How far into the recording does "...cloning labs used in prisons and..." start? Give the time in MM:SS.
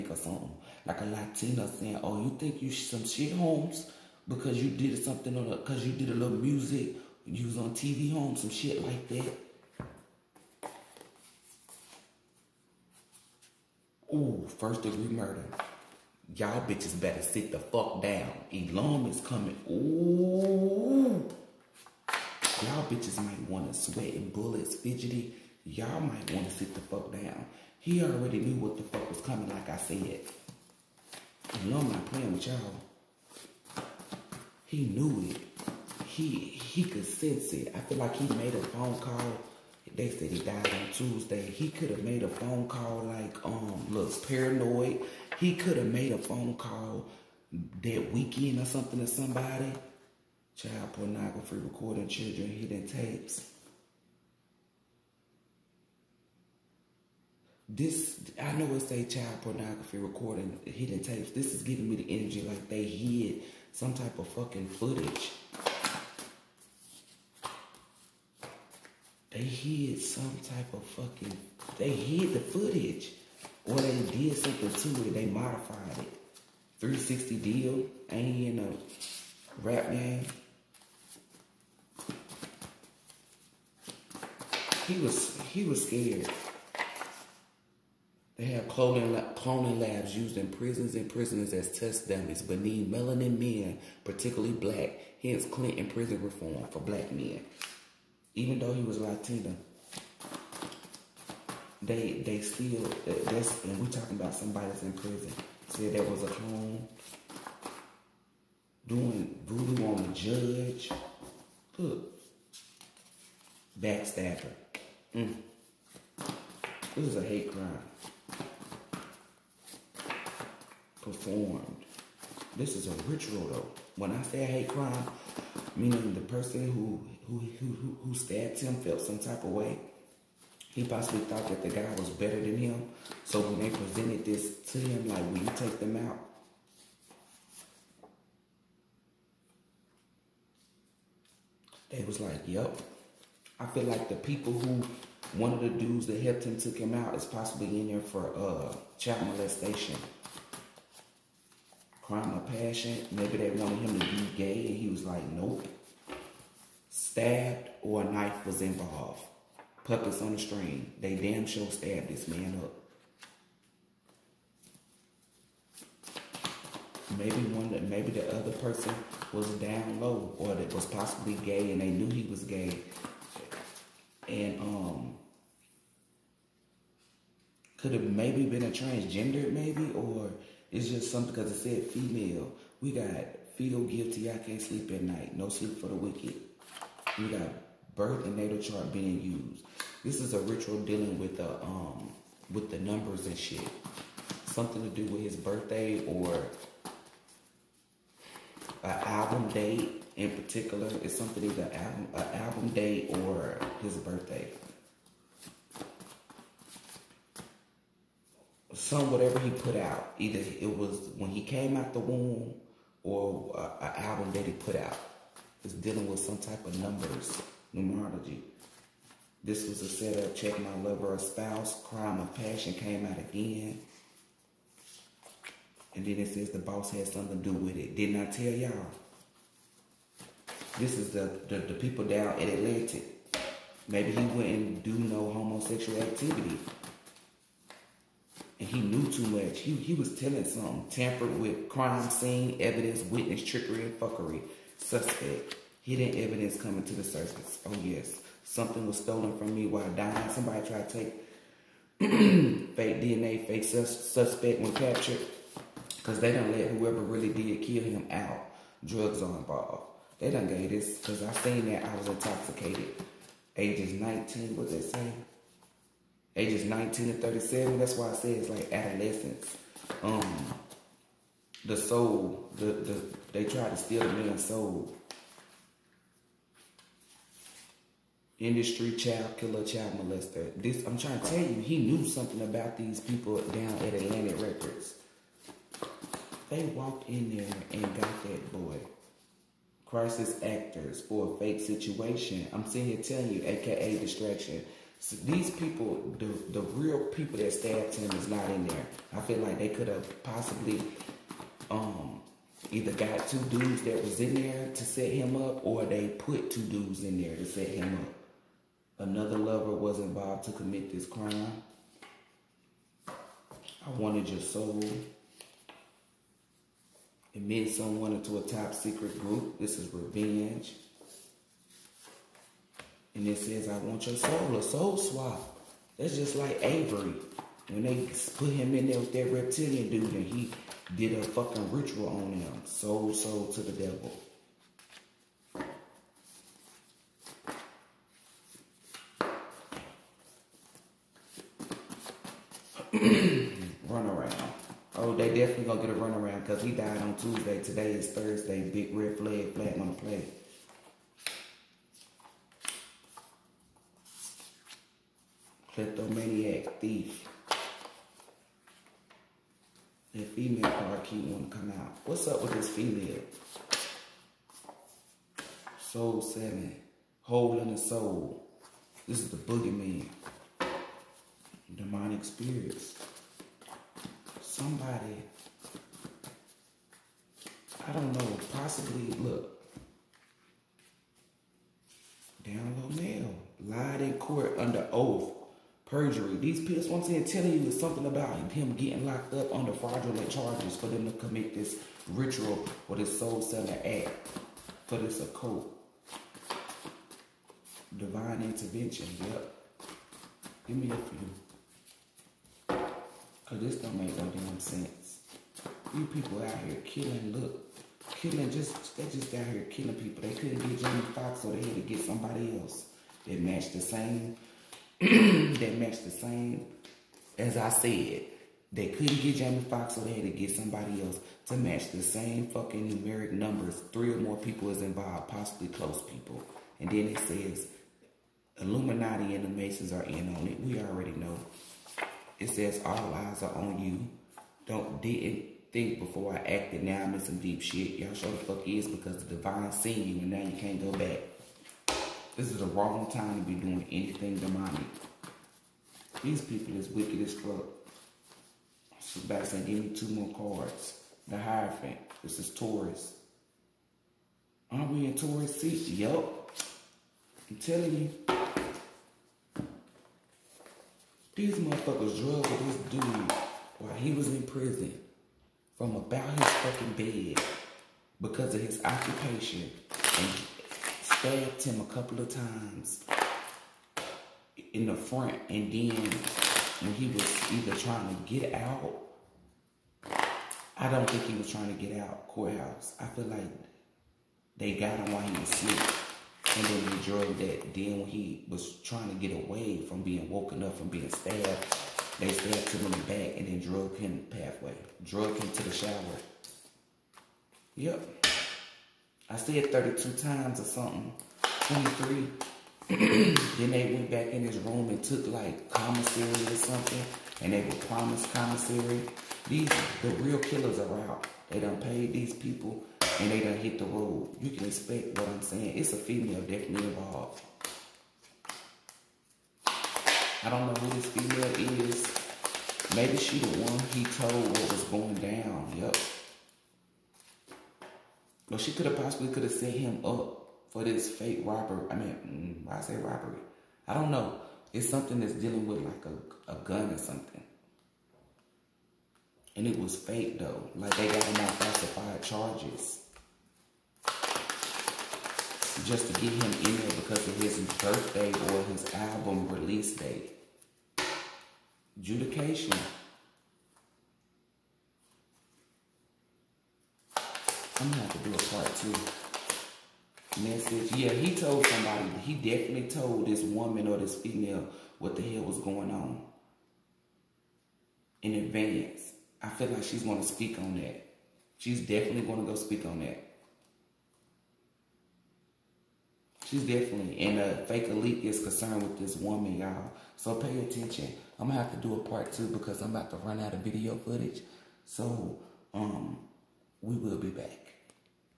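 01:29.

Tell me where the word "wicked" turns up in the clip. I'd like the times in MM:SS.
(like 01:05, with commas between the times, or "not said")
03:05, 07:26.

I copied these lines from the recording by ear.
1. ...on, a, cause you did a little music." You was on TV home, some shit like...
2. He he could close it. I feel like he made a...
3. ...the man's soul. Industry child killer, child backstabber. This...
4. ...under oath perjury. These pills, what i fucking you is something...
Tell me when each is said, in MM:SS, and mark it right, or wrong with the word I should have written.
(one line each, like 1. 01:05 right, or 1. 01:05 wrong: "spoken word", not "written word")
1. 00:05 right
2. 00:36 wrong: "sense", not "close"
3. 04:34 wrong: "molester", not "backstabber"
4. 06:24 wrong: "telling", not "fucking".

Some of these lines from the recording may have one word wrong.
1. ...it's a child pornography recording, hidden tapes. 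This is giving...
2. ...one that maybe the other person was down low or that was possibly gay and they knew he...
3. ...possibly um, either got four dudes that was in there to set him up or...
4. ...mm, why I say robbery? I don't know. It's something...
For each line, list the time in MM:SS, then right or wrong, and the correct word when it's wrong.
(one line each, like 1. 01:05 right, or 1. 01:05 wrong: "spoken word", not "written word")
1. 00:58 right
2. 02:47 right
3. 05:00 wrong: "two", not "four"
4. 08:52 right.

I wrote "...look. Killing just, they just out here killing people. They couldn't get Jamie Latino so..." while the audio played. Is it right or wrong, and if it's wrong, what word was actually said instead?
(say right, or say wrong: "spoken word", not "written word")
wrong: "Foxx", not "Latino".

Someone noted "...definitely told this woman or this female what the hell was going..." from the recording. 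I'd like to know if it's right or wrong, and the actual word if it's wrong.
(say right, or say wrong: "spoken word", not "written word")
right.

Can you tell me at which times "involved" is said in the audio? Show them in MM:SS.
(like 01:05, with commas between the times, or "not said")
02:38, 04:19, 05:09, 07:04, 08:36.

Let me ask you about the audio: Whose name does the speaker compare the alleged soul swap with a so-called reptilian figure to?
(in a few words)
Avery.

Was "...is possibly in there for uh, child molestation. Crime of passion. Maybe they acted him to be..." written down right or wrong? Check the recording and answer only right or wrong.
wrong.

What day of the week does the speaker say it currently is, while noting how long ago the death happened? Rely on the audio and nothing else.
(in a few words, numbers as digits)
Thursday.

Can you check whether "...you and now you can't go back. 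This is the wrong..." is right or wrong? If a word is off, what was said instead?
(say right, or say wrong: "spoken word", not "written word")
right.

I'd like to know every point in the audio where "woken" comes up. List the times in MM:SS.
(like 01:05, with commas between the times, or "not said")
08:10.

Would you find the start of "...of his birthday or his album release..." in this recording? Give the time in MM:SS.
09:07.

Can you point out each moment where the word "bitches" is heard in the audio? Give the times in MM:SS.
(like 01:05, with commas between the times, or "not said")
00:16, 00:22.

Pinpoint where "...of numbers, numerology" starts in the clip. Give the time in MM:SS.
03:36.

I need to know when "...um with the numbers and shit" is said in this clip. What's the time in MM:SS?
03:11.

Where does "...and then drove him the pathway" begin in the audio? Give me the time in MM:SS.
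08:13.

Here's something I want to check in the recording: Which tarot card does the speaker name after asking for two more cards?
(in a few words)
The Hierophant.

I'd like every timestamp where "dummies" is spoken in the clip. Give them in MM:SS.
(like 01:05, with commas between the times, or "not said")
01:32.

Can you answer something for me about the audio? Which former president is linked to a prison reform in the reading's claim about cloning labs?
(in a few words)
Clinton.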